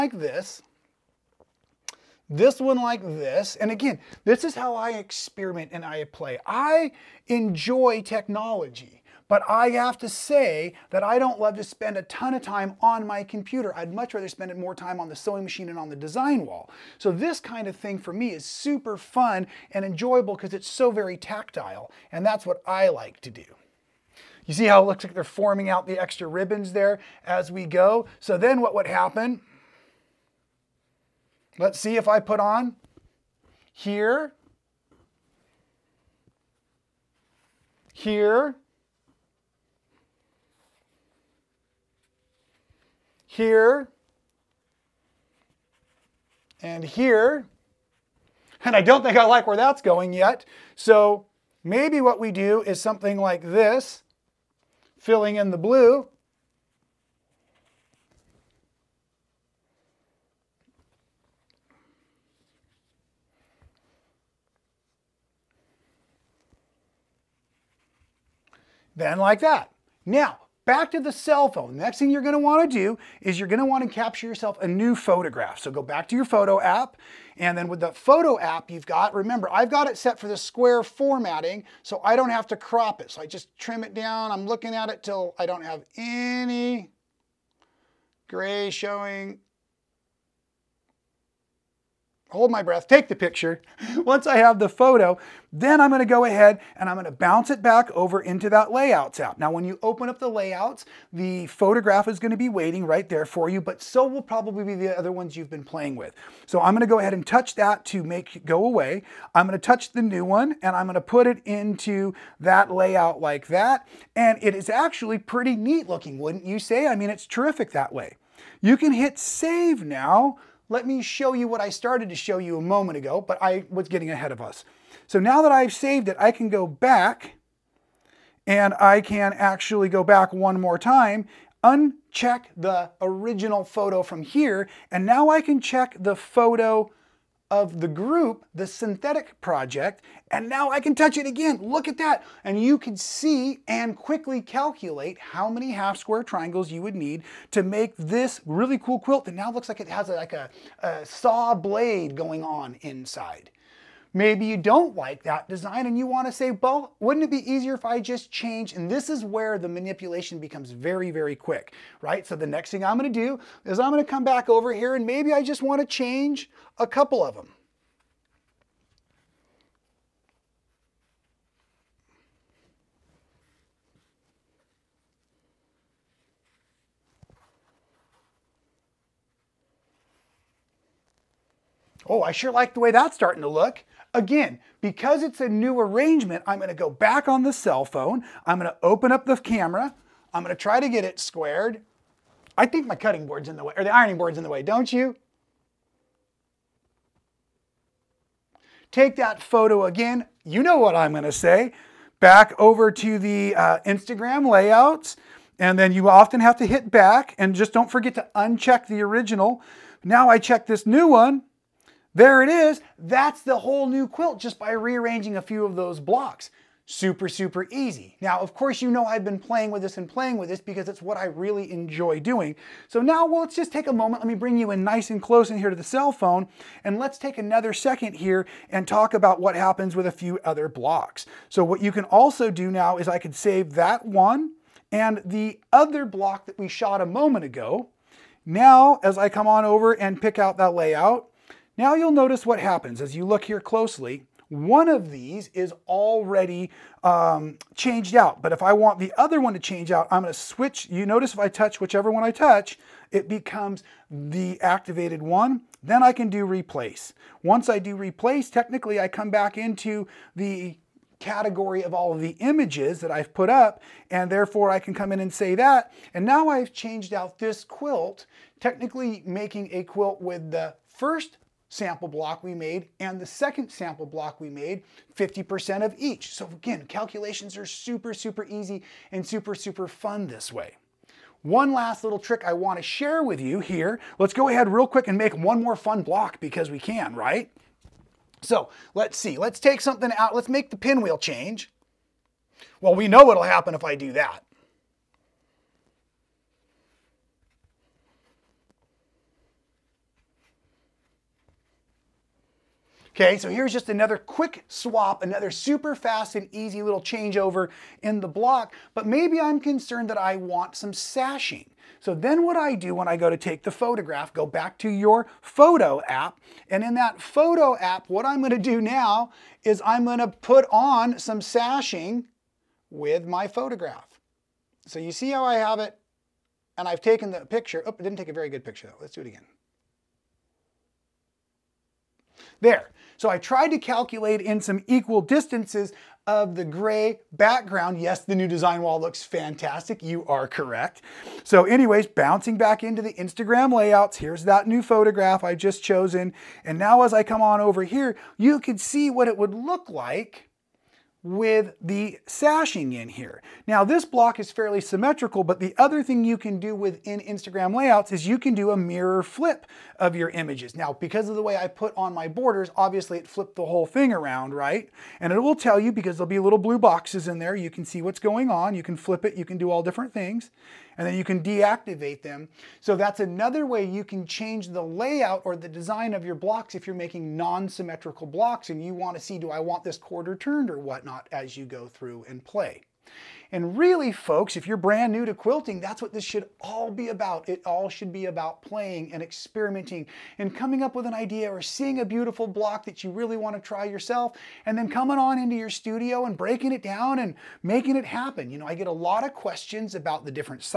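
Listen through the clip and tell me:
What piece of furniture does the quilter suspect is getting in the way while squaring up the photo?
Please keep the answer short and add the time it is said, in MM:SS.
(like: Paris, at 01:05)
ironing board, at 03:13.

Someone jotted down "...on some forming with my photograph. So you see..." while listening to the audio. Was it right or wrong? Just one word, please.
wrong.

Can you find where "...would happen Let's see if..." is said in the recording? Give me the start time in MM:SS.
00:28.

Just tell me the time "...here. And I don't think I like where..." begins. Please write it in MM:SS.
00:46.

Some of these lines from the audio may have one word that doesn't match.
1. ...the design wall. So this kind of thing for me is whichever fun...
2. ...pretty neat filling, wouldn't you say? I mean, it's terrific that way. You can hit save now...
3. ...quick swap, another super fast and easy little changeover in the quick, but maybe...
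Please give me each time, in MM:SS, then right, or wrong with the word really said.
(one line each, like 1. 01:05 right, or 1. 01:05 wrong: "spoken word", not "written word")
1. 00:15 wrong: "super", not "whichever"
2. 01:55 wrong: "looking", not "filling"
3. 05:04 wrong: "block", not "quick".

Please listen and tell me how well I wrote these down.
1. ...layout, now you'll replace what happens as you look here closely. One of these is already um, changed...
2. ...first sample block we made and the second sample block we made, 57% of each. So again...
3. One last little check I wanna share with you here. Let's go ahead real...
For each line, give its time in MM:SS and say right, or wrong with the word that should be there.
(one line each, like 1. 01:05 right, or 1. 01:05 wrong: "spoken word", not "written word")
1. 04:00 wrong: "notice", not "replace"
2. 04:30 wrong: "50", not "57"
3. 04:41 wrong: "trick", not "check".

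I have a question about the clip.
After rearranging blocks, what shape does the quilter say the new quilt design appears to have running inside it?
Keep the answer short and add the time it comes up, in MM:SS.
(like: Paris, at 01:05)
a saw blade, at 02:30.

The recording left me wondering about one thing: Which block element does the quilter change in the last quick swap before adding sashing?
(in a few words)
the pinwheel.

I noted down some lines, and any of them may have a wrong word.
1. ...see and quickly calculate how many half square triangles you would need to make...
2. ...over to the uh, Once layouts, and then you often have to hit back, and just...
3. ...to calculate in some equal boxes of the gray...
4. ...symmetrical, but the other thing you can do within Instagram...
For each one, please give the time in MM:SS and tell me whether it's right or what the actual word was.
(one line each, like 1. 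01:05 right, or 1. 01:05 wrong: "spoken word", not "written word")
1. 02:22 right
2. 03:22 wrong: "Instagram", not "Once"
3. 05:33 wrong: "distances", not "boxes"
4. 05:54 right.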